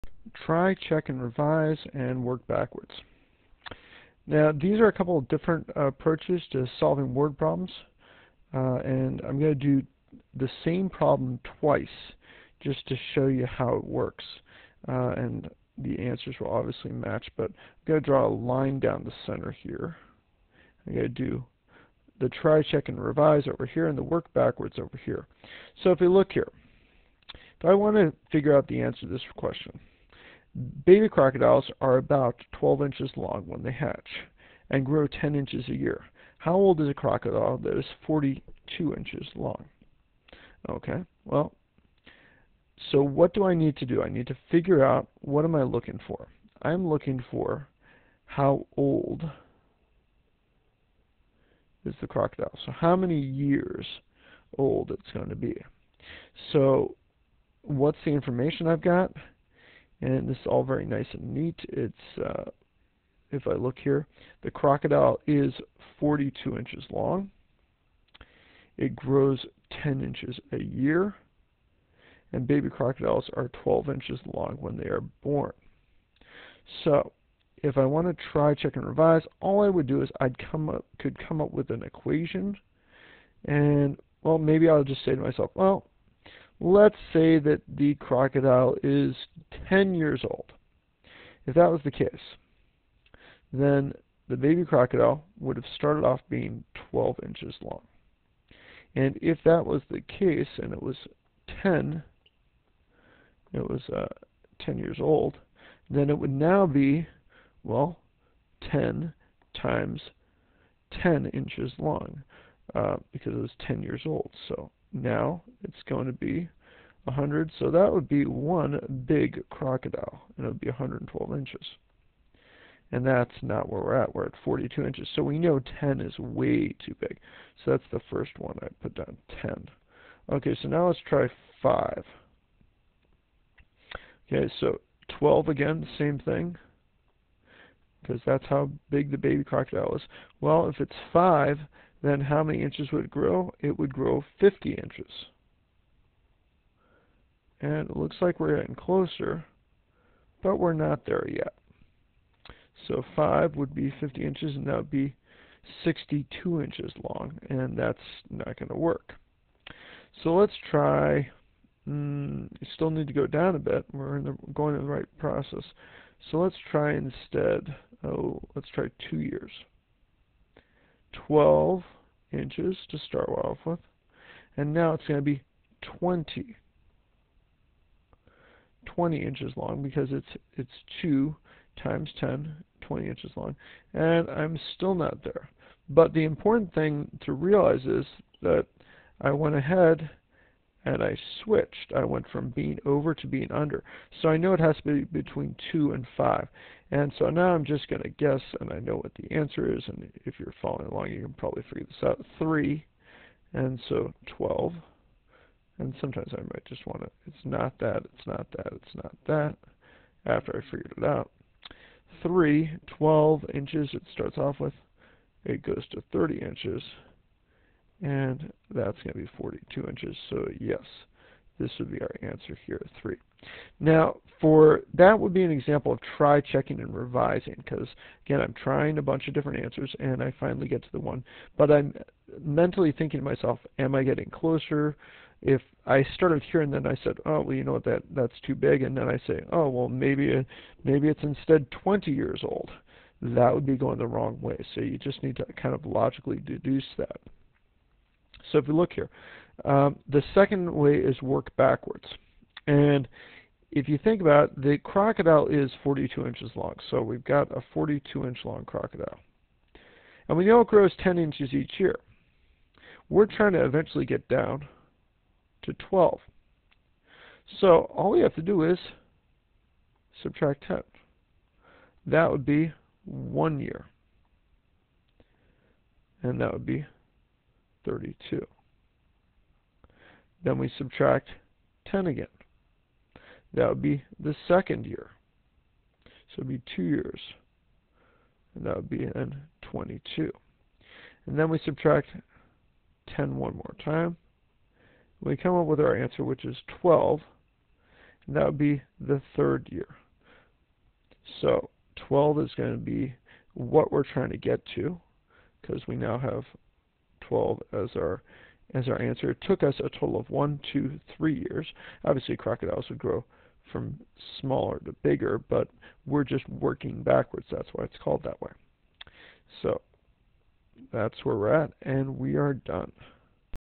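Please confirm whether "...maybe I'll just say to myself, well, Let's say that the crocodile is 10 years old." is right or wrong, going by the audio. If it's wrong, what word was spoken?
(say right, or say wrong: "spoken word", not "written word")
right.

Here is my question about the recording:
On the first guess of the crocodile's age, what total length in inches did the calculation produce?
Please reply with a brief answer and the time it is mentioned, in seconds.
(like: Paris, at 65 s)
112 inches, at 120 s.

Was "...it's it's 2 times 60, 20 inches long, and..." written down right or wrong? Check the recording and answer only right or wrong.
wrong.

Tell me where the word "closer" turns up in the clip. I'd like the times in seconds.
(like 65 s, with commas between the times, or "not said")
148 s, 234 s.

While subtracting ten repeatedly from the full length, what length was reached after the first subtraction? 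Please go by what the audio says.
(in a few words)
32.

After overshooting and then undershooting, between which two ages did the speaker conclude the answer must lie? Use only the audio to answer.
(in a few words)
2 and 5.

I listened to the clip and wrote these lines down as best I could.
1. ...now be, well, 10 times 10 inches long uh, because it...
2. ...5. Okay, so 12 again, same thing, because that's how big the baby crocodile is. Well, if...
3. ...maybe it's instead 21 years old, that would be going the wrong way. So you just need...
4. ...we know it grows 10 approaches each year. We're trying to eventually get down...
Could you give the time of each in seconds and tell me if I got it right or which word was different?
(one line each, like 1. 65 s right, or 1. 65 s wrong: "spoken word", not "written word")
1. 106 s right
2. 131 s right
3. 240 s wrong: "20", not "21"
4. 260 s wrong: "inches", not "approaches".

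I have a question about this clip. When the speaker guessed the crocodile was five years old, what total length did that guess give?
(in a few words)
62 inches.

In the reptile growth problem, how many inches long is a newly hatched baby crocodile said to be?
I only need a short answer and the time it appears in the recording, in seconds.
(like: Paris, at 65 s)
12 inches, at 32 s.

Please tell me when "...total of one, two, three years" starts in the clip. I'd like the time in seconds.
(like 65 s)
309 s.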